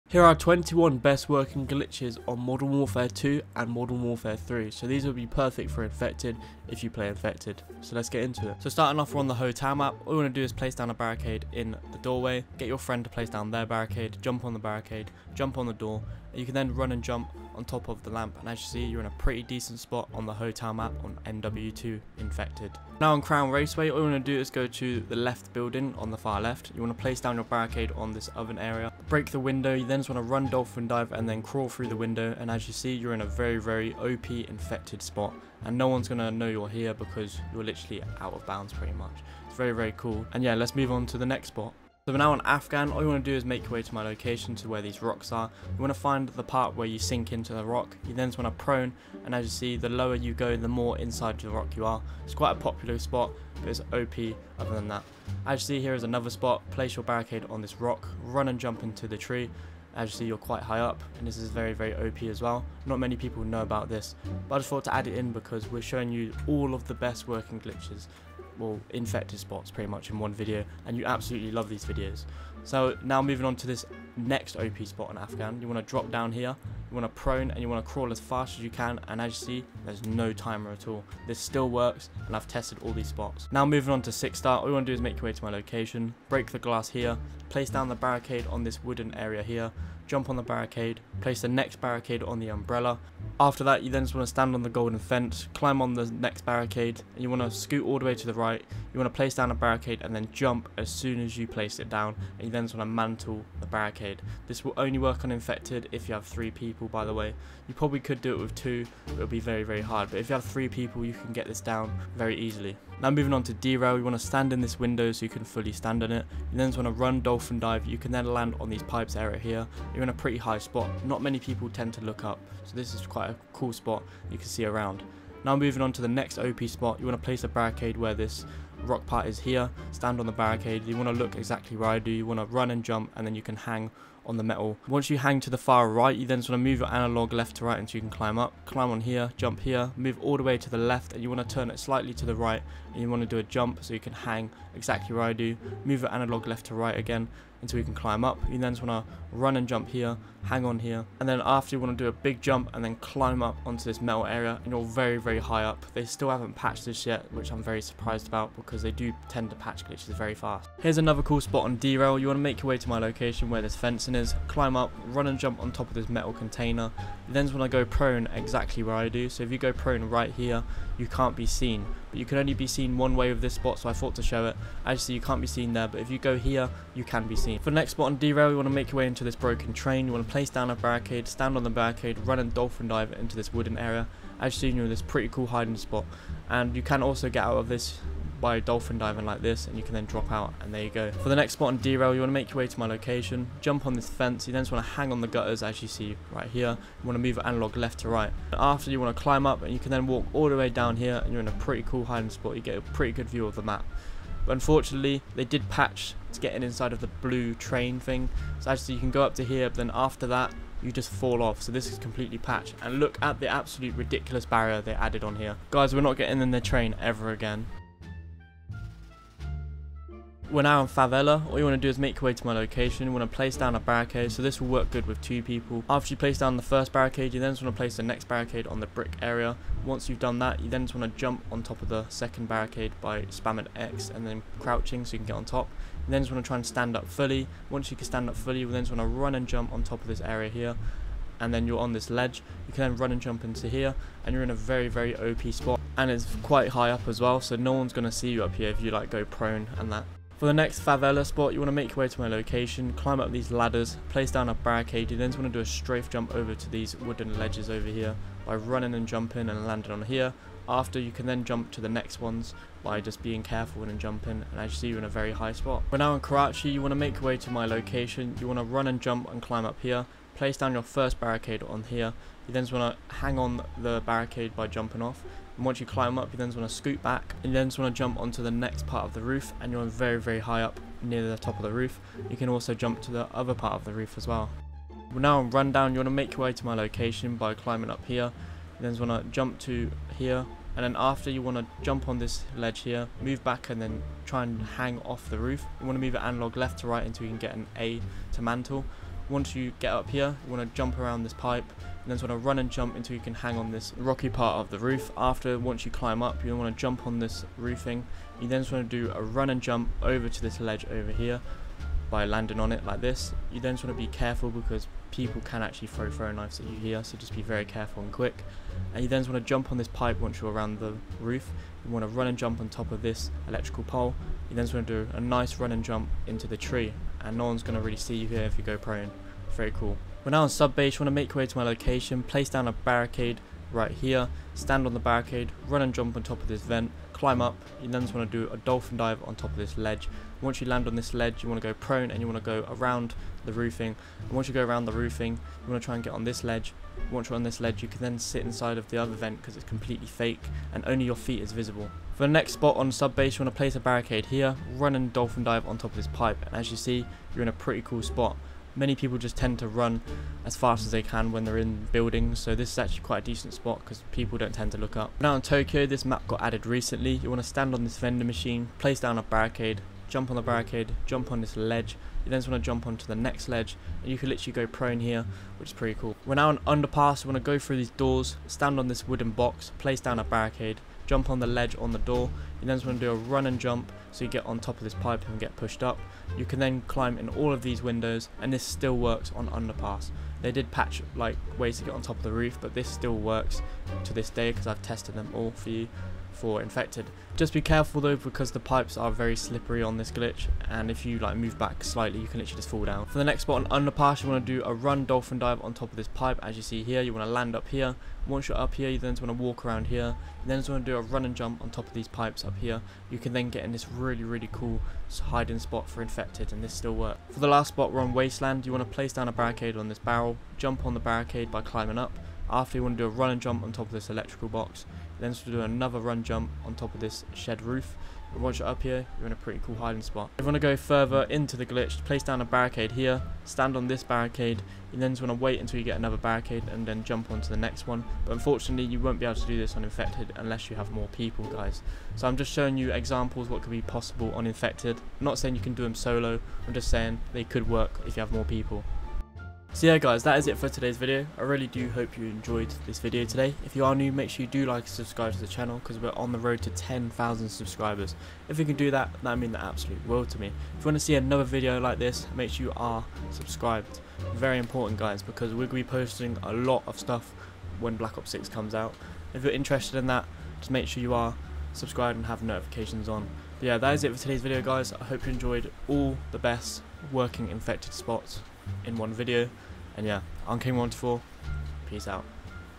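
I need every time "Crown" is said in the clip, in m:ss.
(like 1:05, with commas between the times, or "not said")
0:23.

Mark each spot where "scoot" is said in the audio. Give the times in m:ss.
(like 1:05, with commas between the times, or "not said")
1:37, 4:36.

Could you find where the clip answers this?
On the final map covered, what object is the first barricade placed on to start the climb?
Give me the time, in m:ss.
6:59.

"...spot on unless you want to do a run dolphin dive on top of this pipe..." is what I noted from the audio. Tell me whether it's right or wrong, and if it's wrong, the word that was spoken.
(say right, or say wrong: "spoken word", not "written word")
wrong: "underpass", not "unless".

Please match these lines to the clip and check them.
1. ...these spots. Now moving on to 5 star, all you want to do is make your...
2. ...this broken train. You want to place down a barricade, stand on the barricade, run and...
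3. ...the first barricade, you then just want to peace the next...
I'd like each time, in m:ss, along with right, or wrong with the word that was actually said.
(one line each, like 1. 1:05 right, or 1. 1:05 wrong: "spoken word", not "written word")
1. 1:22 wrong: "6", not "5"
2. 2:59 right
3. 3:46 wrong: "place", not "peace".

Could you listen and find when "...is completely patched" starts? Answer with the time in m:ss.
3:31.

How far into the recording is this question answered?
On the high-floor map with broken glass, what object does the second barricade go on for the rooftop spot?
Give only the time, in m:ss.
1:32.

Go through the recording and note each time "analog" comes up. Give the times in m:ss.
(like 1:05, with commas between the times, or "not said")
2:16, 2:26, 3:17, 4:56.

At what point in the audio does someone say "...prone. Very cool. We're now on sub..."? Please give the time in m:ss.
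5:28.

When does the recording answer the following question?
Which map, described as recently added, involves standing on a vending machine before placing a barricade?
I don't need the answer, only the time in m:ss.
6:05.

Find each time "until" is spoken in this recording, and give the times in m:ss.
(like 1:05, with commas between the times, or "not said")
2:17, 2:27, 4:57, 5:02, 7:15.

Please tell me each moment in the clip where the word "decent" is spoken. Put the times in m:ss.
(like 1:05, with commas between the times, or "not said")
0:19, 6:03.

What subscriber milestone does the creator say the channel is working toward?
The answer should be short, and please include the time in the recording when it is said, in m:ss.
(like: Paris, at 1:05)
10,000, at 7:36.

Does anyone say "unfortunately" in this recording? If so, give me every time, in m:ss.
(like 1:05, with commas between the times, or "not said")
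3:24, 7:18.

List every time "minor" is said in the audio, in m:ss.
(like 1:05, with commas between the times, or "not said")
not said.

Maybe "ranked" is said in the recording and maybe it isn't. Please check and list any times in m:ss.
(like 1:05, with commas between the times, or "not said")
not said.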